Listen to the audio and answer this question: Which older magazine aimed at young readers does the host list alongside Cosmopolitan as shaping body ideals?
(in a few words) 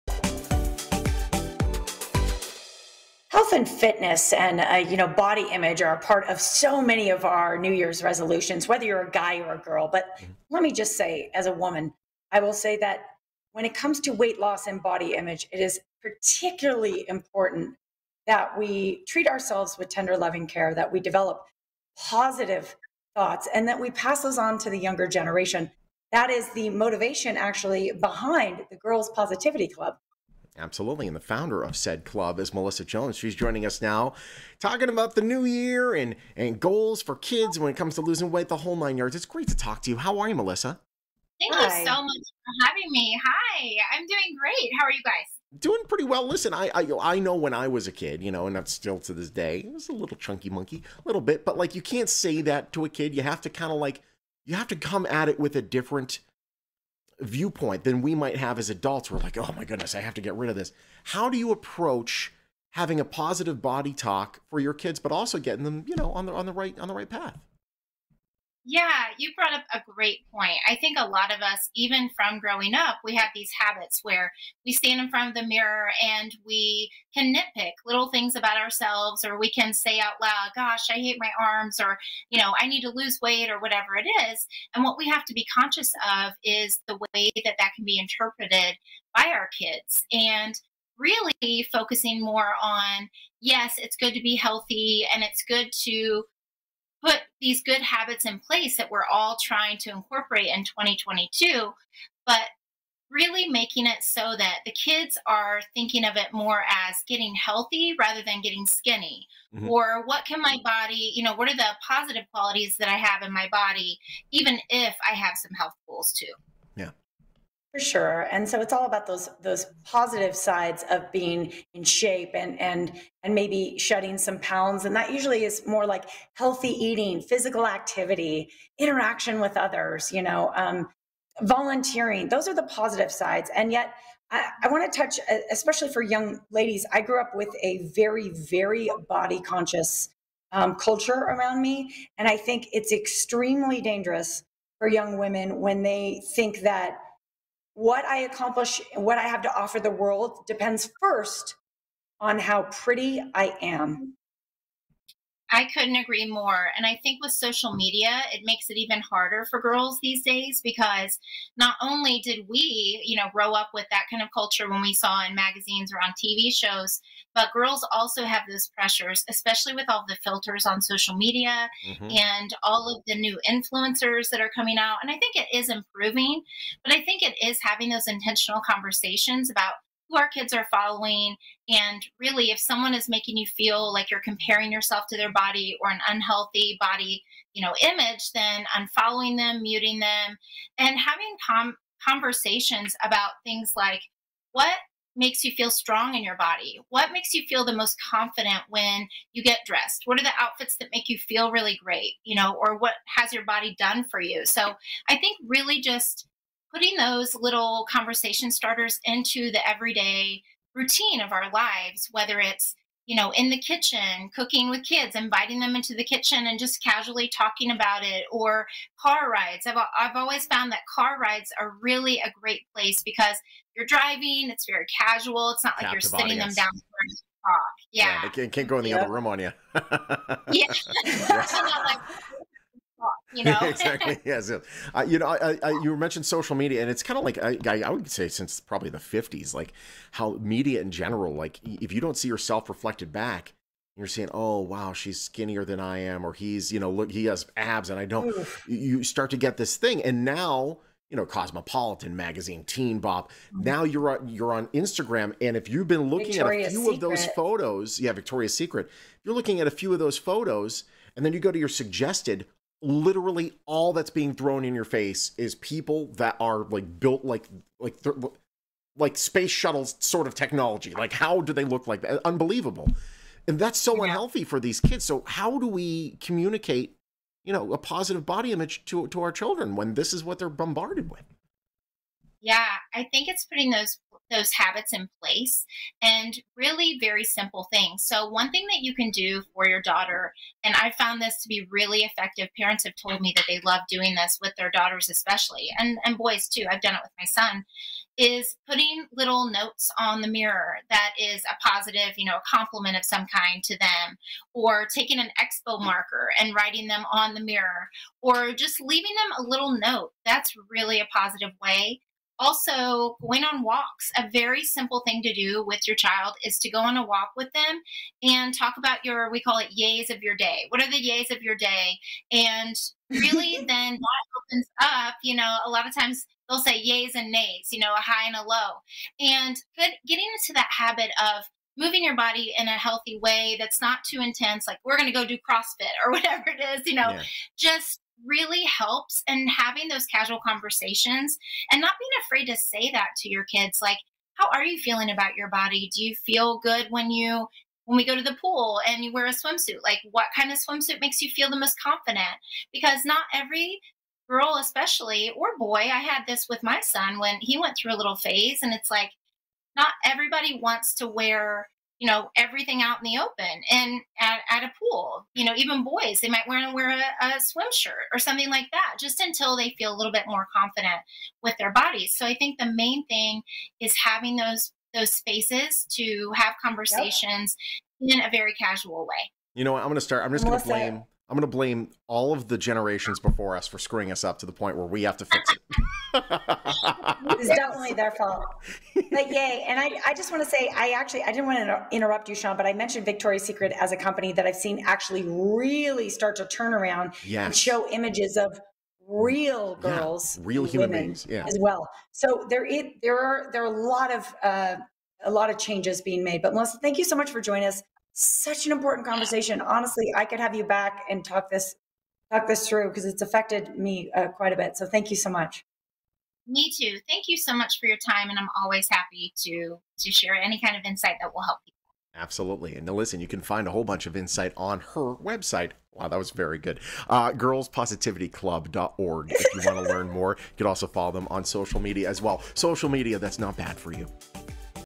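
Teen Bop.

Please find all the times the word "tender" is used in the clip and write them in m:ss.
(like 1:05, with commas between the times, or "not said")
0:19.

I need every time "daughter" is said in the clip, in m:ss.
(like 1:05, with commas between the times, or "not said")
4:49, 4:54.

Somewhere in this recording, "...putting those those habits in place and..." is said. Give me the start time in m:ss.
4:43.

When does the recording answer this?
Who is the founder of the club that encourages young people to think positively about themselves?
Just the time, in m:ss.
0:32.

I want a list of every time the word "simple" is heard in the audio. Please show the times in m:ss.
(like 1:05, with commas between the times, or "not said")
4:47, 5:14.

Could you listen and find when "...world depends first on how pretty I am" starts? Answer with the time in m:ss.
2:29.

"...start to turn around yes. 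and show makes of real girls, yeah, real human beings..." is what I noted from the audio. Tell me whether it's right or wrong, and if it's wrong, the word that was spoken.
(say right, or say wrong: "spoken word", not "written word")
wrong: "images", not "makes".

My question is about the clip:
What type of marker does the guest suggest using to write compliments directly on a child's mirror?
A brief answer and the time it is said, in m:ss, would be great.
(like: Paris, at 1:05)
Expo marker, at 5:05.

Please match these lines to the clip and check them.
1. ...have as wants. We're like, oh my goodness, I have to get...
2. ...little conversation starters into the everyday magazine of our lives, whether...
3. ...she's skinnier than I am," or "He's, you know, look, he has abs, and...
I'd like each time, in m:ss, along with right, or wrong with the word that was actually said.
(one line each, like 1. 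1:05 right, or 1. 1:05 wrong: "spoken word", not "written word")
1. 0:58 wrong: "adults", not "wants"
2. 3:27 wrong: "routine", not "magazine"
3. 4:04 right.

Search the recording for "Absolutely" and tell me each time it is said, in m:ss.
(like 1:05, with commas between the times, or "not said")
0:30, 7:02.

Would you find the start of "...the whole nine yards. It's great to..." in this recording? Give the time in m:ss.
0:38.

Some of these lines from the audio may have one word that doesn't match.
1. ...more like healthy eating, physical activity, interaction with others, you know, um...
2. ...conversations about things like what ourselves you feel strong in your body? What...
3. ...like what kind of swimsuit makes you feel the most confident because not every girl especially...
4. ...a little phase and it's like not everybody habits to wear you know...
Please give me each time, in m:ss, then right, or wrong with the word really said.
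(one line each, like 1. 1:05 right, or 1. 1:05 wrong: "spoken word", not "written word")
1. 2:05 right
2. 3:12 wrong: "makes", not "ourselves"
3. 5:49 right
4. 5:57 wrong: "wants", not "habits".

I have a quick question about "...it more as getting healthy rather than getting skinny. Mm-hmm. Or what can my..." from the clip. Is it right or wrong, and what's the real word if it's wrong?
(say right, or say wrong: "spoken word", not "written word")
right.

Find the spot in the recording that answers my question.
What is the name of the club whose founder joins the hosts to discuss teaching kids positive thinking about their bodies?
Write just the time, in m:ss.
0:28.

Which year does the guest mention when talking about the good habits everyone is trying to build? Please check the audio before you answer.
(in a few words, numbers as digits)
2022.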